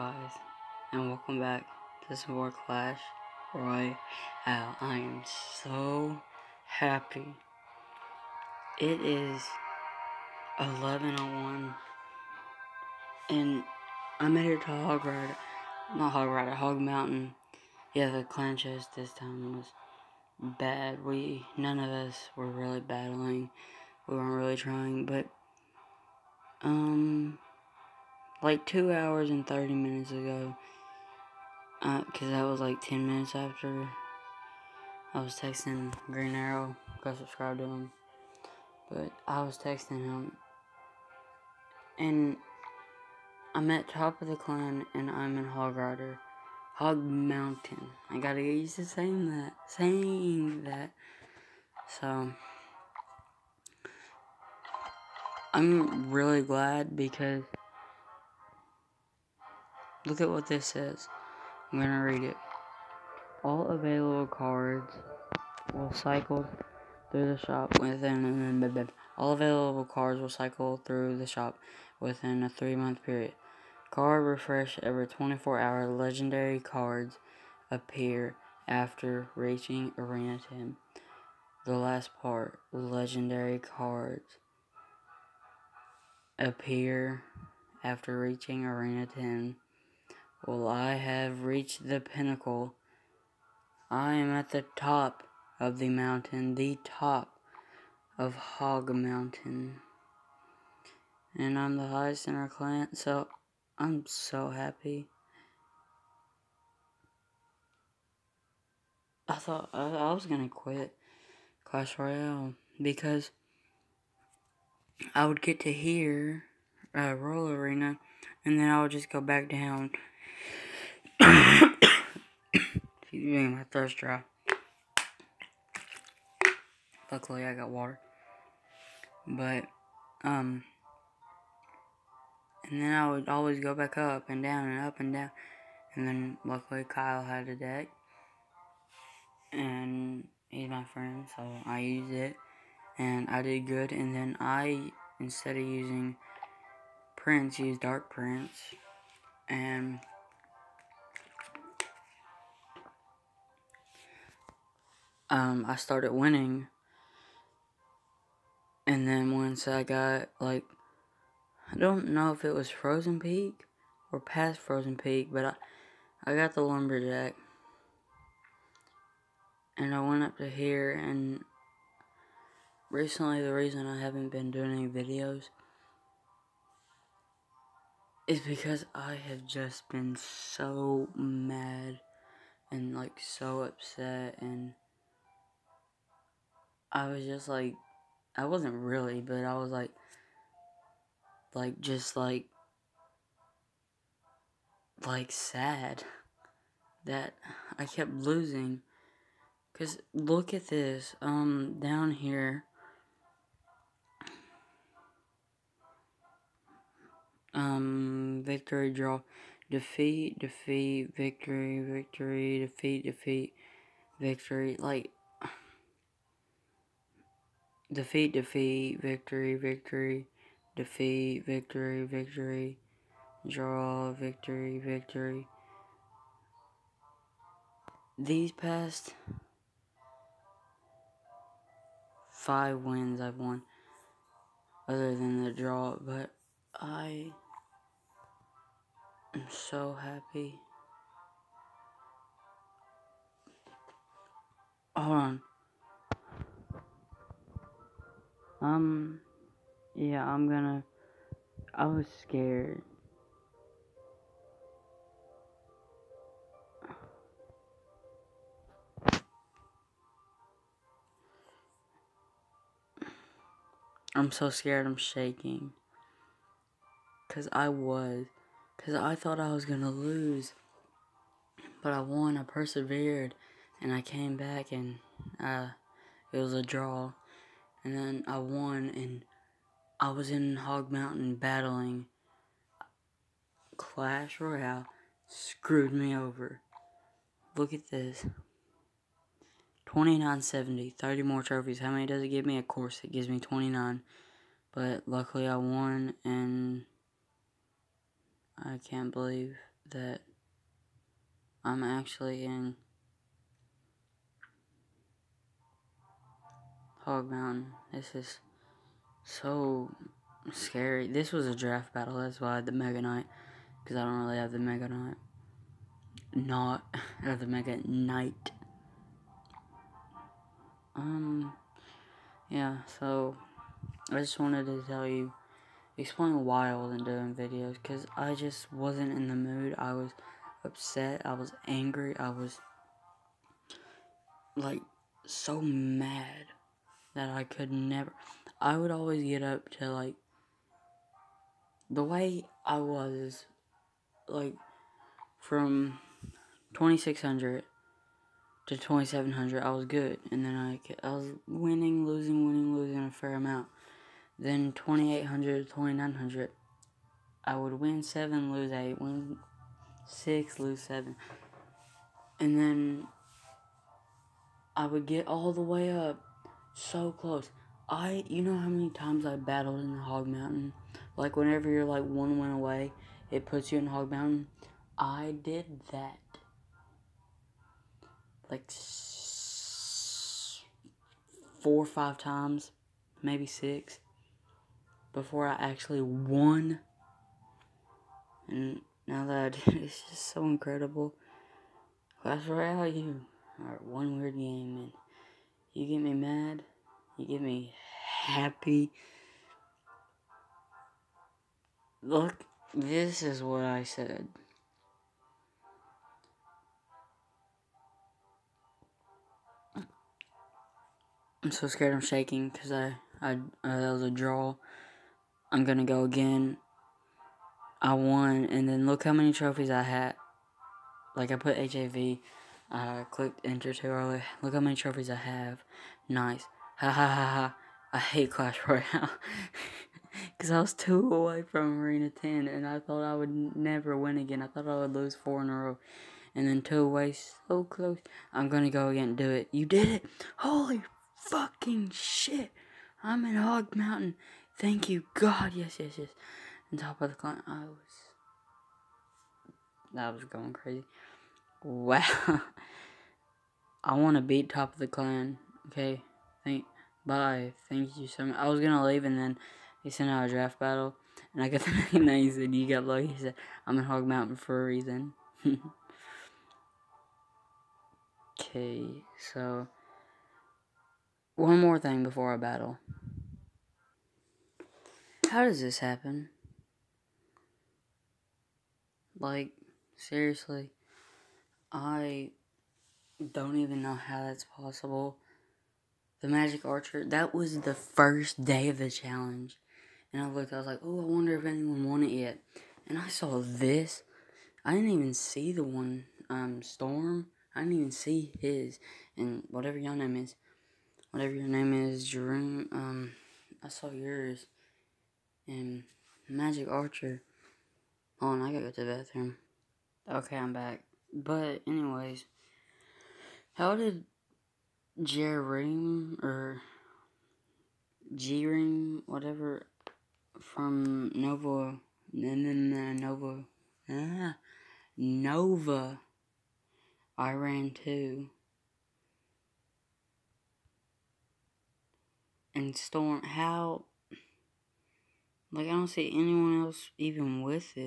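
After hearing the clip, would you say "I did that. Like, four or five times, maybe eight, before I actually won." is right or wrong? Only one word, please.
wrong.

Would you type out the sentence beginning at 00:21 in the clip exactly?
We, none of us were really battling.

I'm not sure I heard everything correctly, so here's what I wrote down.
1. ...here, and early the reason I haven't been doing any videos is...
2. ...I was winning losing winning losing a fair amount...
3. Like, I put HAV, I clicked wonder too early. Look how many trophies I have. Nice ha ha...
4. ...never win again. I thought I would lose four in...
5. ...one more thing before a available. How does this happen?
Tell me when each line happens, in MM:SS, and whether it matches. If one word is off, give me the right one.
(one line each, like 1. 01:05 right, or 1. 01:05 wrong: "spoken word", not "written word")
1. 02:50 wrong: "recently", not "early"
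2. 05:51 right
3. 07:01 wrong: "enter", not "wonder"
4. 07:13 right
5. 07:51 wrong: "battle", not "available".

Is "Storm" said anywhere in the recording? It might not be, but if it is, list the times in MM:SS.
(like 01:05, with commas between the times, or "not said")
08:16, 08:52.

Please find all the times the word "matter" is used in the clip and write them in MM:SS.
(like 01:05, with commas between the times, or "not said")
not said.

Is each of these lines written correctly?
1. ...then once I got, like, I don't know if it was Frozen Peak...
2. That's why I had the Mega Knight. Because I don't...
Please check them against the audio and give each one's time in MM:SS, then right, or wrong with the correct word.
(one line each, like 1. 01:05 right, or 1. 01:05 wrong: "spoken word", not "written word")
1. 02:39 right
2. 05:12 right.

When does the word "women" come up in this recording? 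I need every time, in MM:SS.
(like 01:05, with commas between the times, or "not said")
not said.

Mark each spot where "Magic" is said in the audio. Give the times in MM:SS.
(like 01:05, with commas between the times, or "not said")
08:06, 08:26.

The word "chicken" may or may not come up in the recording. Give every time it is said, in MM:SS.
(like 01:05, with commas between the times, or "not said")
not said.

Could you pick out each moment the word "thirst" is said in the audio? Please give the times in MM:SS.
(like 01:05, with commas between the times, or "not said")
02:03.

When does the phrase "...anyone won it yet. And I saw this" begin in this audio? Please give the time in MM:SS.
08:11.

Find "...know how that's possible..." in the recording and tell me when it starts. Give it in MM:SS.
08:03.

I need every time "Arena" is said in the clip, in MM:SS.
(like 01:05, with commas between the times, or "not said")
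01:19, 01:28, 01:57, 07:11.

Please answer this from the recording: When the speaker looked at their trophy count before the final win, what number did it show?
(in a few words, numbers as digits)
2970.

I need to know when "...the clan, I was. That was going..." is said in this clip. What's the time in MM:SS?
07:27.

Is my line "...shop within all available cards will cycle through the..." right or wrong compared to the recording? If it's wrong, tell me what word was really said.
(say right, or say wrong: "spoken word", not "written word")
right.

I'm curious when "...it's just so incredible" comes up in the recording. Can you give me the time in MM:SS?
06:29.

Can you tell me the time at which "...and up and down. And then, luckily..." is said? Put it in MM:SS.
02:14.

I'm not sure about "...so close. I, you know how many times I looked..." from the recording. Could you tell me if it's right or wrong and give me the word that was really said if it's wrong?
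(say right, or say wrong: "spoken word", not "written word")
wrong: "battled", not "looked".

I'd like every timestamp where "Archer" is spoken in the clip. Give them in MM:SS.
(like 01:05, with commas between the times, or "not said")
08:06, 08:26.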